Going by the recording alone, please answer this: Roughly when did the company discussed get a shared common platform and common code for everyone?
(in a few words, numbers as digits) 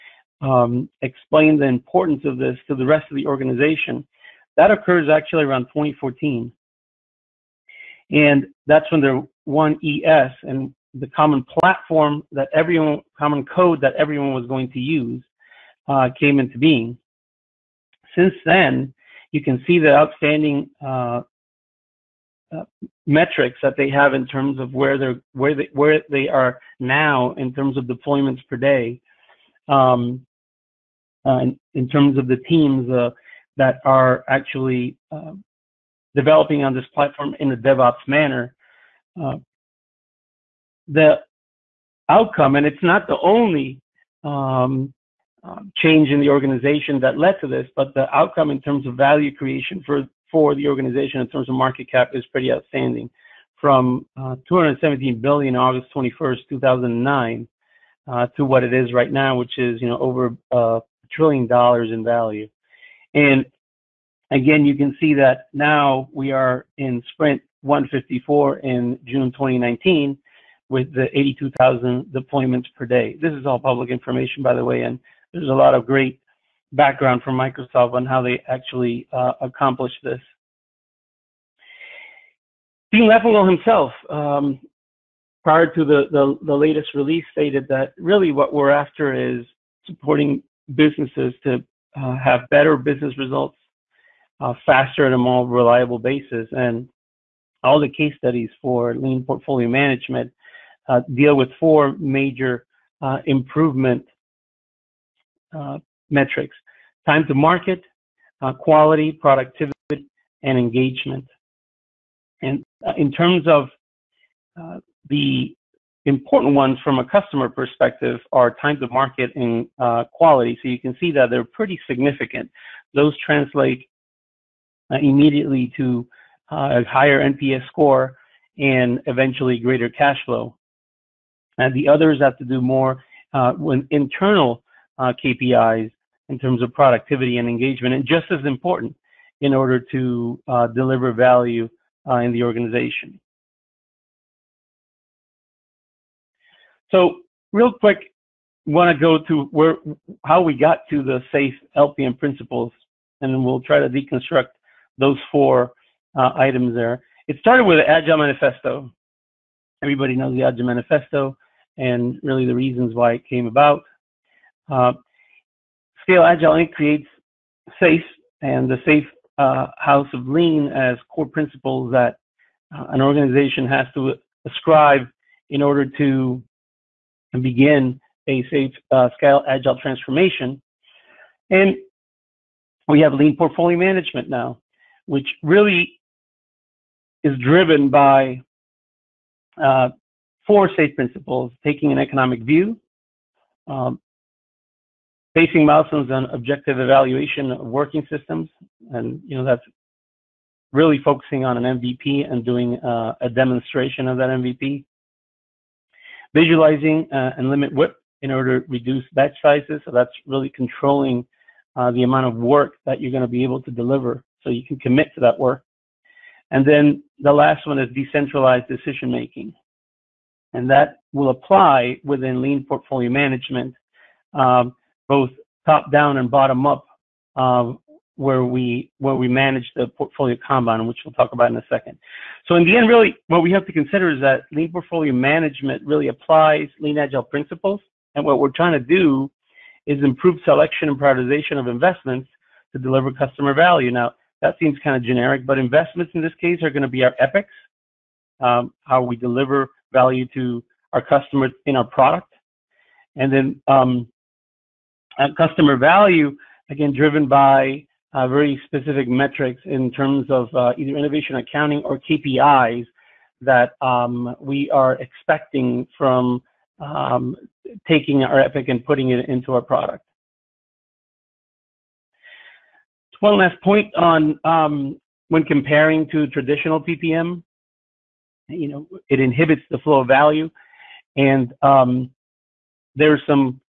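2014.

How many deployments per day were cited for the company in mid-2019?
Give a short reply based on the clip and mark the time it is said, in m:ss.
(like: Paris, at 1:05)
82,000, at 1:11.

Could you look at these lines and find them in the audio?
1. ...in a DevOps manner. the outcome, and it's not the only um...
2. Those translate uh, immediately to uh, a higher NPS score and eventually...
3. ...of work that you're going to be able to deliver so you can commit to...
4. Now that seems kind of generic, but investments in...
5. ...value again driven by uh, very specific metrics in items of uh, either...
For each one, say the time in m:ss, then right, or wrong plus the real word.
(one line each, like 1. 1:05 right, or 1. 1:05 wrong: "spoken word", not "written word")
1. 0:37 right
2. 2:02 right
3. 3:32 right
4. 4:03 right
5. 4:15 wrong: "terms", not "items".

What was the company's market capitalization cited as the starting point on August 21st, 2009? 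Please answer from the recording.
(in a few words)
217 billion.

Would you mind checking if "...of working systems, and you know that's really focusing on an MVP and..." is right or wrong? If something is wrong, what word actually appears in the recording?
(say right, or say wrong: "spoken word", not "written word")
right.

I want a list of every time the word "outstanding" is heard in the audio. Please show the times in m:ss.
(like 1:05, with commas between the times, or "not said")
0:19, 0:52.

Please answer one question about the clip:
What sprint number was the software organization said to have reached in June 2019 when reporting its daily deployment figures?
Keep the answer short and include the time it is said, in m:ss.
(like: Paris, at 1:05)
154, at 1:07.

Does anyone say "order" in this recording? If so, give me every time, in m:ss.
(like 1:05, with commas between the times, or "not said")
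2:19, 2:55, 3:28.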